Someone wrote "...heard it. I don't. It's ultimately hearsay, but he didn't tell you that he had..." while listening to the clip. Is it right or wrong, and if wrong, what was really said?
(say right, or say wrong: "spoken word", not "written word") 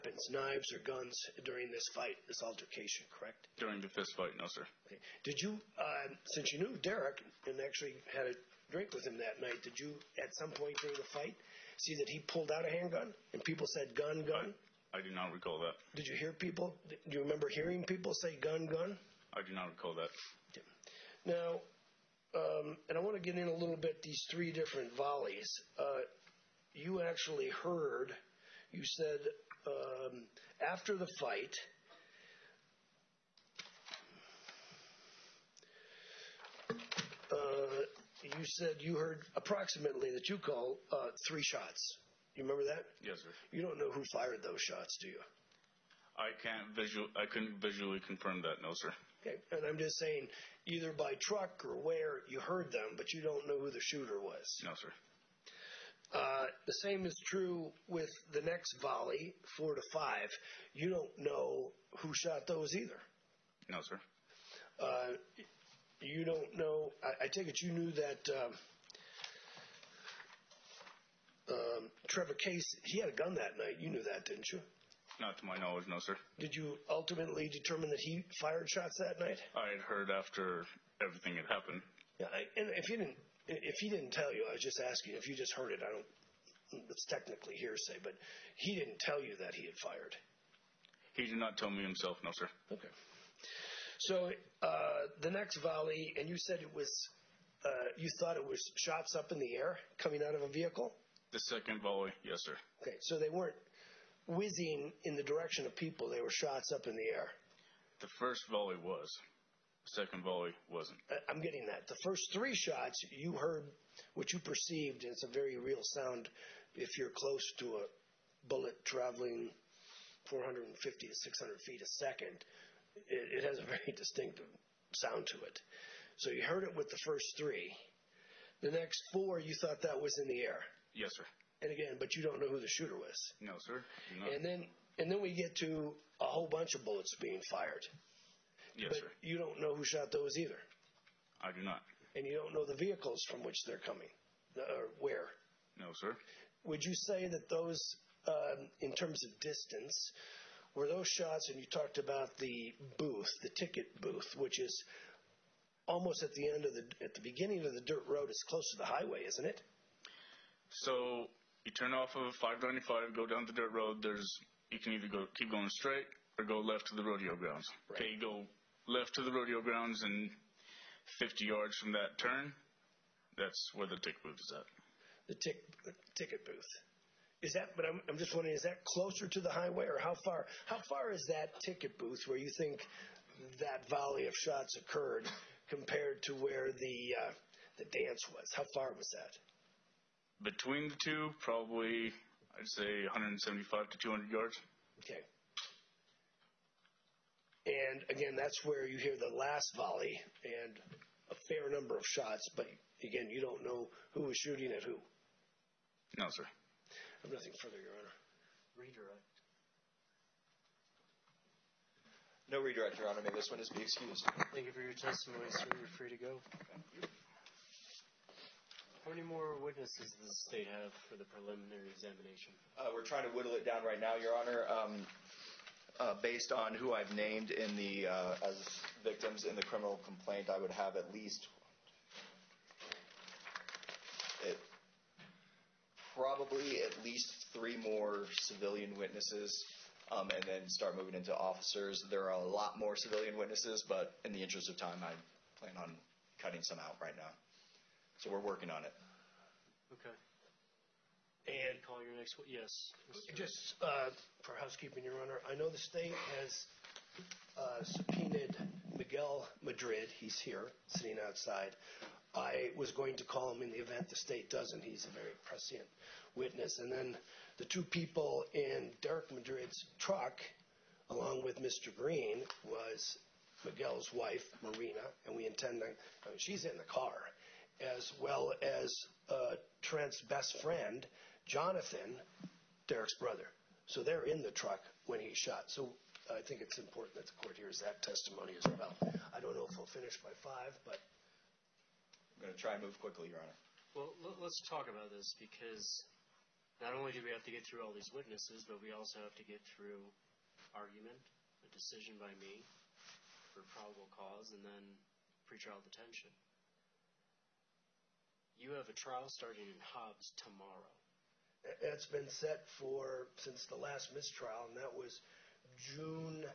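wrong: "technically", not "ultimately".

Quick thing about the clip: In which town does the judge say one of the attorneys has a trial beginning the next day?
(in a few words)
Hobbs.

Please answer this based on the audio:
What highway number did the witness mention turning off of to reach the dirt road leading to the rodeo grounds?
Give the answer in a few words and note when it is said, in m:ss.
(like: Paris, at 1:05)
595, at 2:42.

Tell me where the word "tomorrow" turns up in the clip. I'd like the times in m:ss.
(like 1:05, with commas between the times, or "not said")
5:10.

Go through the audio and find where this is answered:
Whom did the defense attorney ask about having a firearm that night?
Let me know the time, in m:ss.
1:12.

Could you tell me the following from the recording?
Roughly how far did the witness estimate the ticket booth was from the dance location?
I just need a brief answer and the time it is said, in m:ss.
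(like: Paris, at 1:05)
175 to 200 yards, at 3:13.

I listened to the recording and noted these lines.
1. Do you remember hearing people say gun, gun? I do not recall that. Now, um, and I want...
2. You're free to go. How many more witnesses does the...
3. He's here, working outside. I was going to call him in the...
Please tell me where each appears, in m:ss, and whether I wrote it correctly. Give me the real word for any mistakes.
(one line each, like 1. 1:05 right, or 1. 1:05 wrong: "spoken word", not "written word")
1. 0:16 right
2. 3:35 right
3. 4:20 wrong: "sitting", not "working".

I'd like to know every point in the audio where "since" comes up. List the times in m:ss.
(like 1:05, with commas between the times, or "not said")
0:06, 5:13.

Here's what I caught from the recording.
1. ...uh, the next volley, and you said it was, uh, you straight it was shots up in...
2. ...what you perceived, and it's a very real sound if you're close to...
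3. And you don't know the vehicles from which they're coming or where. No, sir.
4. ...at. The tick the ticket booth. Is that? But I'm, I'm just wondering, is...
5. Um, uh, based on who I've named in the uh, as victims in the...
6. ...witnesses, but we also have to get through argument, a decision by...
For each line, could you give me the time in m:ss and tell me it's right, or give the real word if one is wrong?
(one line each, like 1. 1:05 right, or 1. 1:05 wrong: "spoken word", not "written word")
1. 1:34 wrong: "thought", not "straight"
2. 1:54 right
3. 2:22 right
4. 2:54 right
5. 3:44 right
6. 4:58 right.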